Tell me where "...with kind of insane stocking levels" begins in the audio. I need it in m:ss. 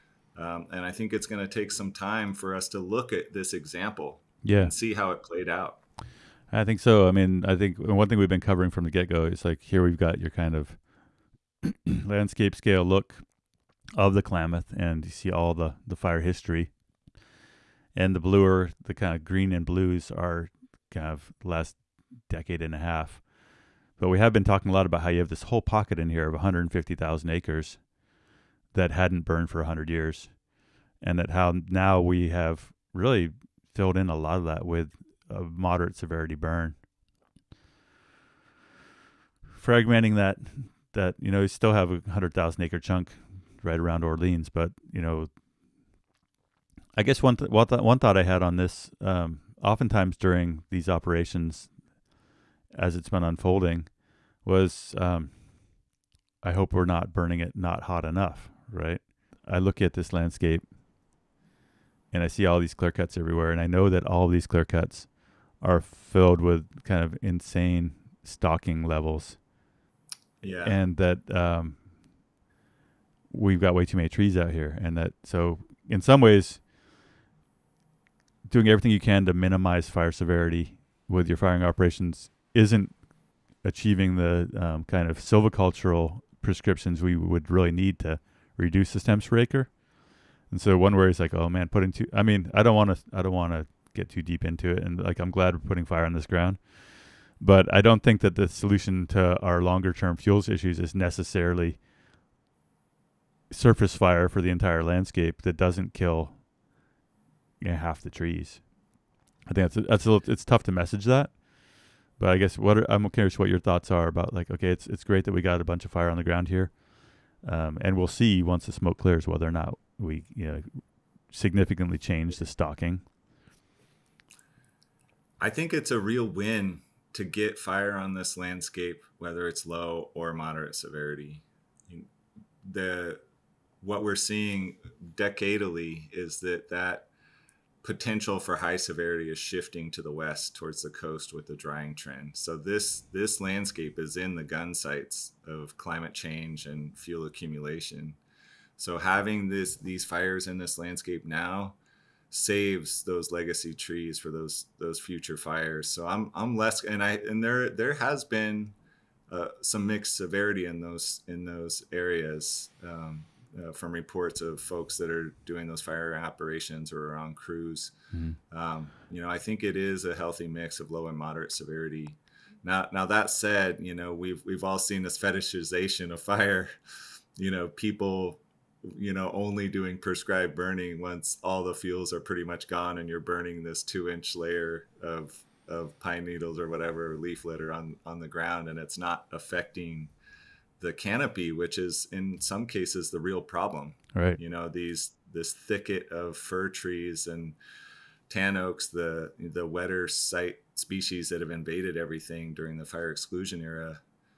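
1:06.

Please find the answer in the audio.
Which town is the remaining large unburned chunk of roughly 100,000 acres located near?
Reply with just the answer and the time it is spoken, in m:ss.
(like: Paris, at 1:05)
Orleans, at 0:44.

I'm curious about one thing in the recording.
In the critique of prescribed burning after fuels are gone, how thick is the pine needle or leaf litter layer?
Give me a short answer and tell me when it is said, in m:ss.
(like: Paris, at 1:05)
2 inches, at 3:03.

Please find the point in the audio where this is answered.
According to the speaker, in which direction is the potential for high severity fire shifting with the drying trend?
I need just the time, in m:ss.
2:19.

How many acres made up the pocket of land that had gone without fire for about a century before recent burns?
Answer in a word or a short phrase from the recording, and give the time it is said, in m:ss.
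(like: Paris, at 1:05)
150,000, at 0:26.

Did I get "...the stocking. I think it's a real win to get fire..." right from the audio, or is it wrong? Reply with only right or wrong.
right.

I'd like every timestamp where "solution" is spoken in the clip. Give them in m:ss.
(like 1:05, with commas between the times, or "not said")
1:38.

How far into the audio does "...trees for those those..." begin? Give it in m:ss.
2:33.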